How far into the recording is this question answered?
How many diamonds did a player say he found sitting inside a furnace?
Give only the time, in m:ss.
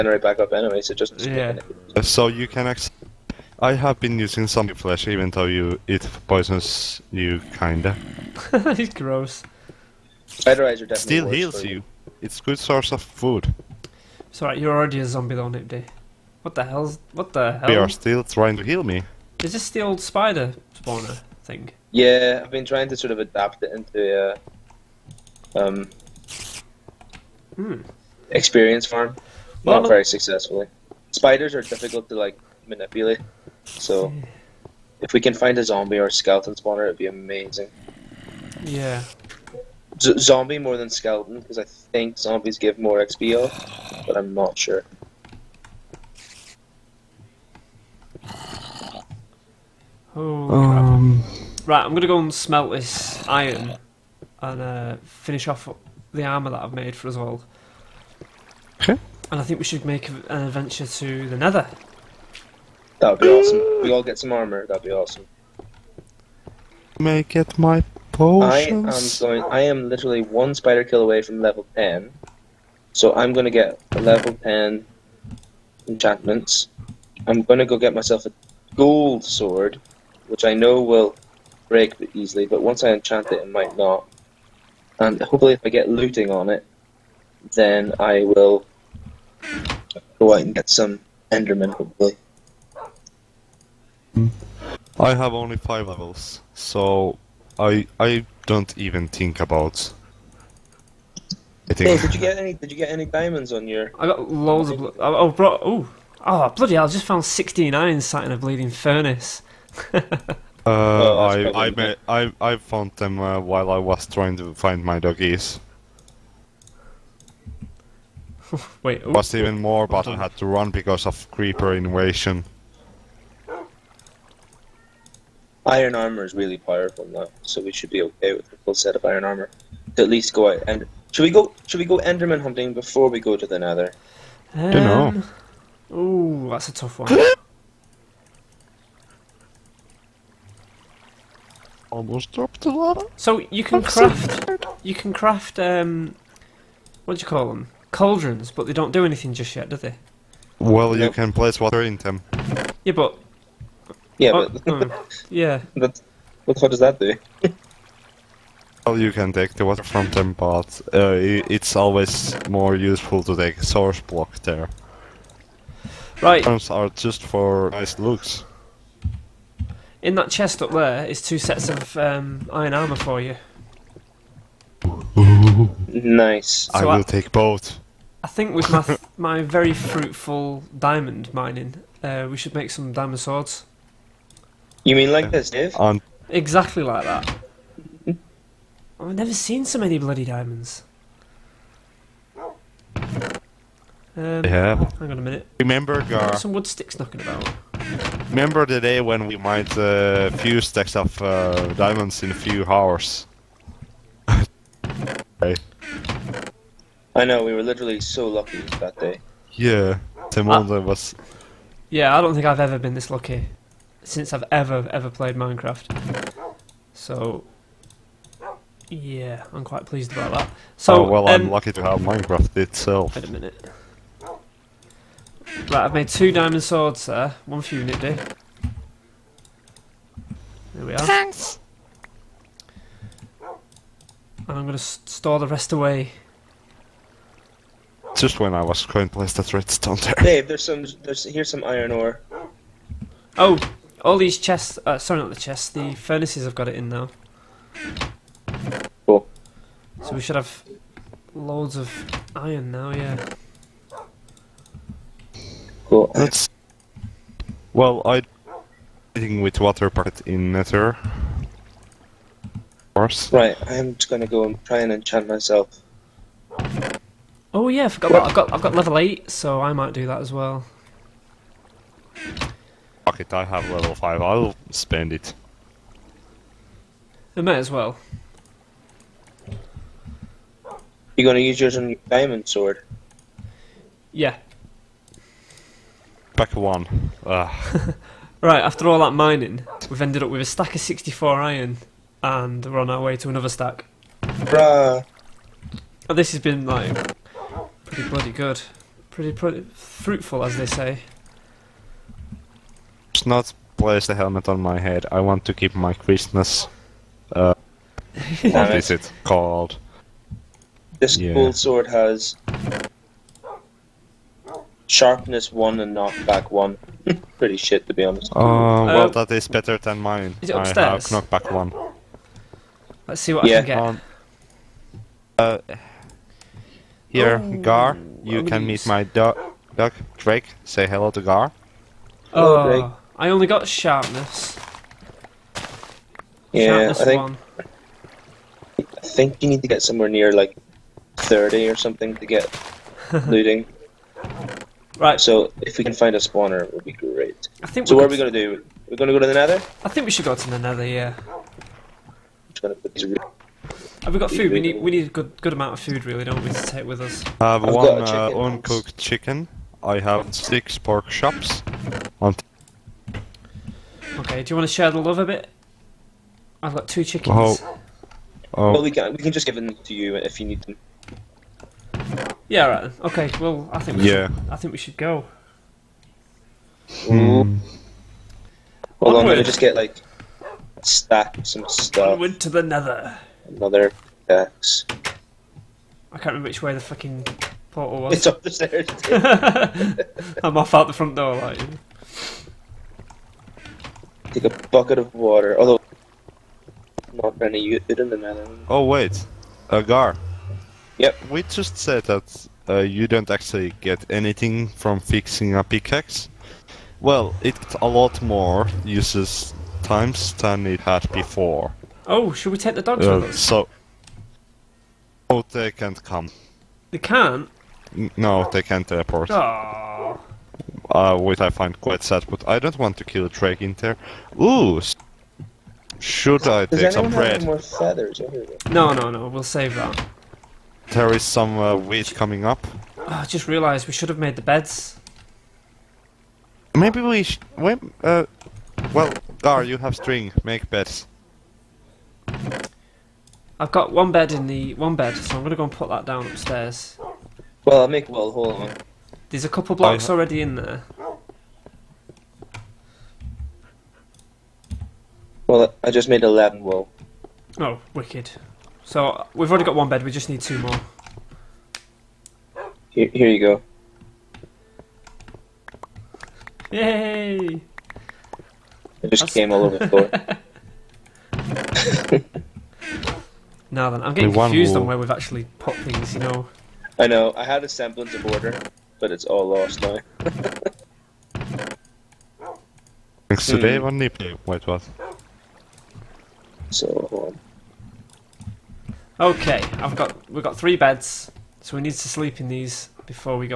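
1:47.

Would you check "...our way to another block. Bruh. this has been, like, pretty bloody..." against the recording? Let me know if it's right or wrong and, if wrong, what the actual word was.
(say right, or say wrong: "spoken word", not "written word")
wrong: "stack", not "block".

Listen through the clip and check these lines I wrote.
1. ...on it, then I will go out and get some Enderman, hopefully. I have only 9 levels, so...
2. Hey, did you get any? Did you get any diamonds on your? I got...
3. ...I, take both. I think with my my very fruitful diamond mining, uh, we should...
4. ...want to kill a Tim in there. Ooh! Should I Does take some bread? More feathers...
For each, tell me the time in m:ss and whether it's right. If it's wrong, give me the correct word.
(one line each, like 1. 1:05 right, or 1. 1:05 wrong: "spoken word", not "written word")
1. 1:26 wrong: "5", not "9"
2. 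1:41 right
3. 2:56 right
4. 7:02 wrong: "Drake", not "Tim".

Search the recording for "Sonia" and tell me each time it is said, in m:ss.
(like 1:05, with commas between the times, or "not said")
not said.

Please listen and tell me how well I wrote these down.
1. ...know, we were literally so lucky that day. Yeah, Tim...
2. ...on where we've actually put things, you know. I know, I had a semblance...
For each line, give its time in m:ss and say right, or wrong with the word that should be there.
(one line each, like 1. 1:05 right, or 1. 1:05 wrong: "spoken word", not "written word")
1. 3:27 right
2. 7:54 right.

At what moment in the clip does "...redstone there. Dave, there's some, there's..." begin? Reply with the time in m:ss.
3:59.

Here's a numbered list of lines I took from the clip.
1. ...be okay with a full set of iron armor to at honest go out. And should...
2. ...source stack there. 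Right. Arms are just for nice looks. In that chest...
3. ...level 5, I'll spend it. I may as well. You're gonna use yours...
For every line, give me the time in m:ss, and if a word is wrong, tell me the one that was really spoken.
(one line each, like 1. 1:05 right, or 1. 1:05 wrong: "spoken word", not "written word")
1. 2:07 wrong: "least", not "honest"
2. 2:43 wrong: "block", not "stack"
3. 4:33 right.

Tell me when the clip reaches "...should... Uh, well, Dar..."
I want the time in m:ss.
7:17.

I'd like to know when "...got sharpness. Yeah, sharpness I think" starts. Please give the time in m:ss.
5:33.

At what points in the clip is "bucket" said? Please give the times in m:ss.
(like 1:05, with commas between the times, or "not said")
6:34.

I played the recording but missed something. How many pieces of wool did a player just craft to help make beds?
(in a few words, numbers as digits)
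11.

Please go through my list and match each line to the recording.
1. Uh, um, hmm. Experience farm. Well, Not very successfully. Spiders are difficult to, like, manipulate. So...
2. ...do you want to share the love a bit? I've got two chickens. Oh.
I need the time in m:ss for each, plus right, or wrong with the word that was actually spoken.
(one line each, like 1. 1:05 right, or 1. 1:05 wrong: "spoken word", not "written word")
1. 0:25 right
2. 6:04 right.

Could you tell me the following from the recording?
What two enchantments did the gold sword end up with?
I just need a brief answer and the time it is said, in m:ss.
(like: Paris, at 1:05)
Sharpness 1 and Knockback 1, at 5:14.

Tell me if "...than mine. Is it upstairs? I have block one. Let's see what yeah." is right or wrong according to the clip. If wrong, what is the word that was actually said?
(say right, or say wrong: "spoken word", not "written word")
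wrong: "knockback", not "block".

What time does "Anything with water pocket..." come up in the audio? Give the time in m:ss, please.
4:19.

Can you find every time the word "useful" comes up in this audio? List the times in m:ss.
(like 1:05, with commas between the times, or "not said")
2:42.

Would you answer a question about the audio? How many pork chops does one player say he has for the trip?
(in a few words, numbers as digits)
6.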